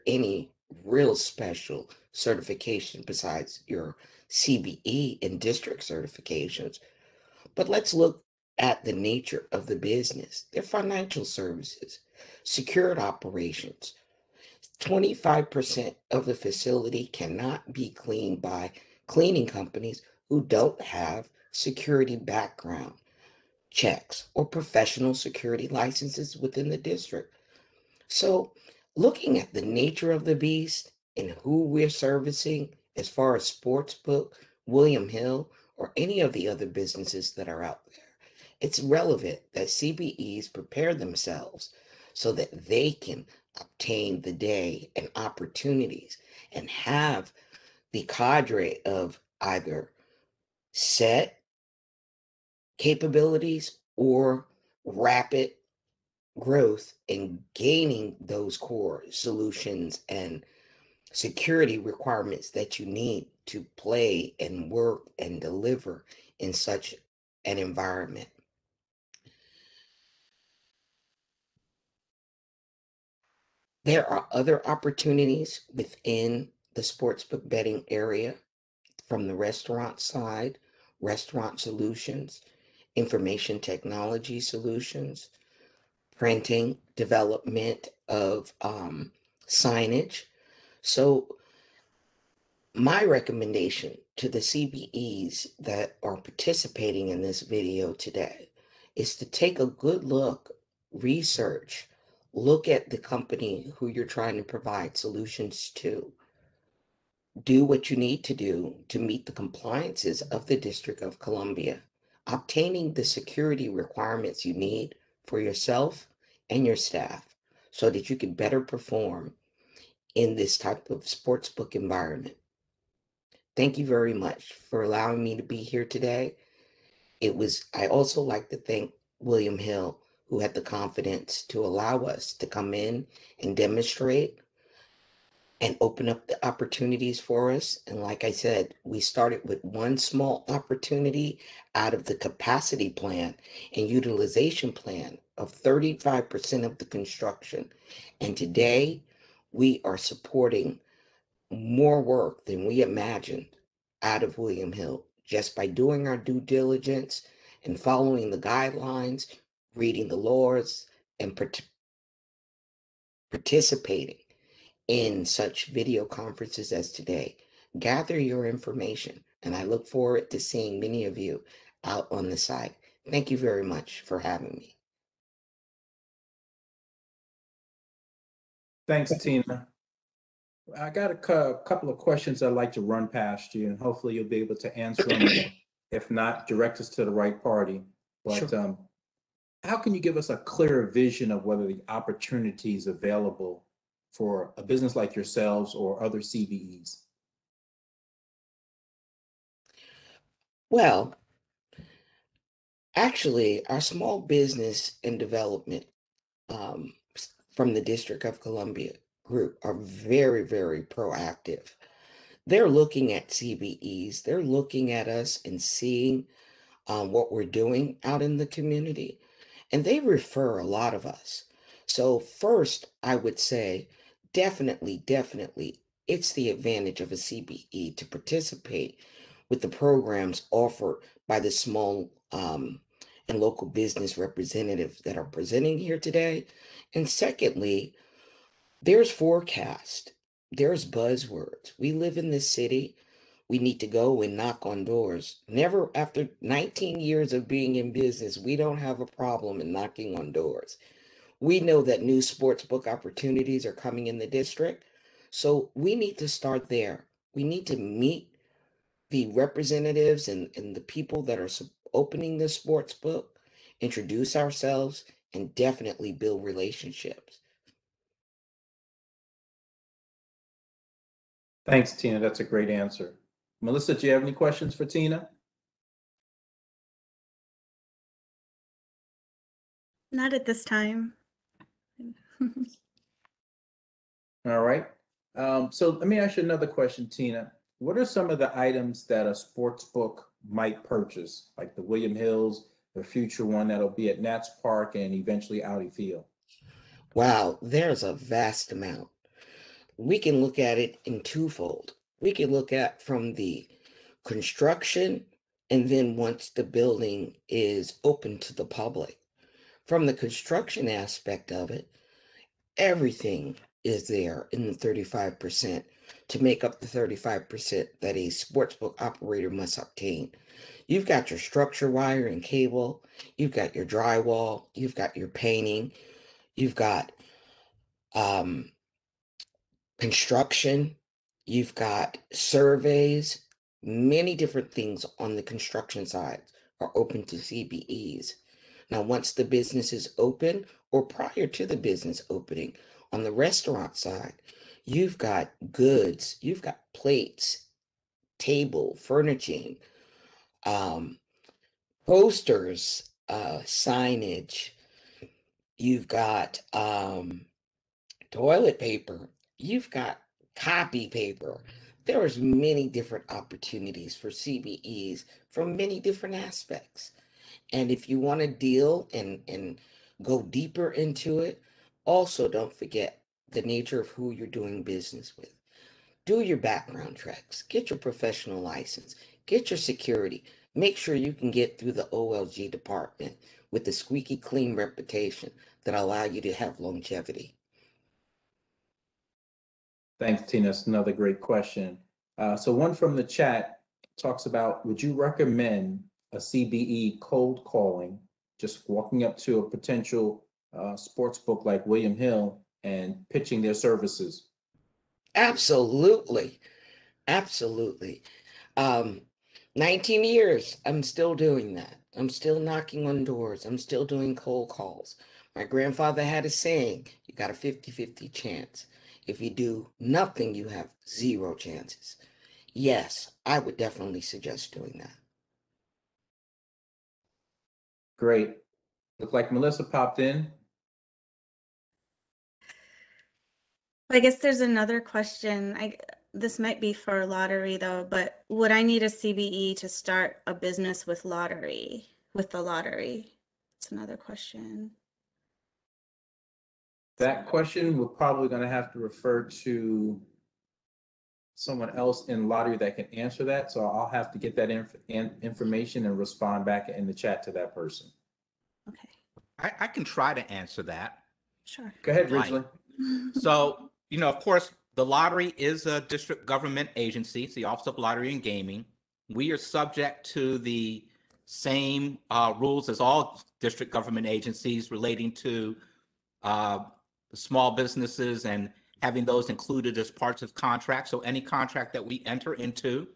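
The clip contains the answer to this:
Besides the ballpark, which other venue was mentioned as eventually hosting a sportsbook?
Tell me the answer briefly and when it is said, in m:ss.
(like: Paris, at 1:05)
Audi Field, at 4:55.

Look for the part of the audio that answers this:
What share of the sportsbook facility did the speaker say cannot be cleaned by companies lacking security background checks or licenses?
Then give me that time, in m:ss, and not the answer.
0:14.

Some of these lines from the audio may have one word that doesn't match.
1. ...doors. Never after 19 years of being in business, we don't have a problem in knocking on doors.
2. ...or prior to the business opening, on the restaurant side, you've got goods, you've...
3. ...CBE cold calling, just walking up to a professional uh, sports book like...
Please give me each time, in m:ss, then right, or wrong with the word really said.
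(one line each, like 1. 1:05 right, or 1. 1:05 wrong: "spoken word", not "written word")
1. 4:04 right
2. 5:40 right
3. 6:36 wrong: "potential", not "professional".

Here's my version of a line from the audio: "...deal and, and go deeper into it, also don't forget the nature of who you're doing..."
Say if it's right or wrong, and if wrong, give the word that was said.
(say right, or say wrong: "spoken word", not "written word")
right.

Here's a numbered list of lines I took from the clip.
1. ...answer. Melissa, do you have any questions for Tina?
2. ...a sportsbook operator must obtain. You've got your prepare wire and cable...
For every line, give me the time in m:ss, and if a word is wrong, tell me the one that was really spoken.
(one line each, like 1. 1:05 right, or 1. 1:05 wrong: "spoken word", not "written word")
1. 4:32 right
2. 5:18 wrong: "structure", not "prepare".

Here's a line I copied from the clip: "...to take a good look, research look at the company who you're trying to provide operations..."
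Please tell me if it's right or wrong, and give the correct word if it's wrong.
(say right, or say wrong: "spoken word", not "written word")
wrong: "solutions", not "operations".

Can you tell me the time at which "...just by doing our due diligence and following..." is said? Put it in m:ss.
2:35.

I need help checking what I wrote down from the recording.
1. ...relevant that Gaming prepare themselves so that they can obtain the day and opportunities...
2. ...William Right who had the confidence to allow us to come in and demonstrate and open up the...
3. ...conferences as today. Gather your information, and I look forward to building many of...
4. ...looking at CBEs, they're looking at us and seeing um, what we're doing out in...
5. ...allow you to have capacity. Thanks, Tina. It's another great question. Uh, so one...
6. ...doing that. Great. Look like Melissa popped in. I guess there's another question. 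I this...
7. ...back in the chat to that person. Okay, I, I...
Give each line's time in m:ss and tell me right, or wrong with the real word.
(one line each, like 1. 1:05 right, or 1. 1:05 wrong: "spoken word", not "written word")
1. 0:38 wrong: "CBEs", not "Gaming"
2. 2:09 wrong: "Hill", not "Right"
3. 2:46 wrong: "seeing", not "building"
4. 3:32 right
5. 6:25 wrong: "longevity", not "capacity"
6. 7:04 right
7. 7:36 right.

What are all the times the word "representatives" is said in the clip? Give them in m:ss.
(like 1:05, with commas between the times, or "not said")
3:54, 4:19.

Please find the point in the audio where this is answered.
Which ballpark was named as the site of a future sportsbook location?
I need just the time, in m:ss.
4:54.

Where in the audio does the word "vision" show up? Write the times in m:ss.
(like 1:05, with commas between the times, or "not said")
3:10.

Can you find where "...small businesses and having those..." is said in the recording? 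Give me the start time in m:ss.
7:57.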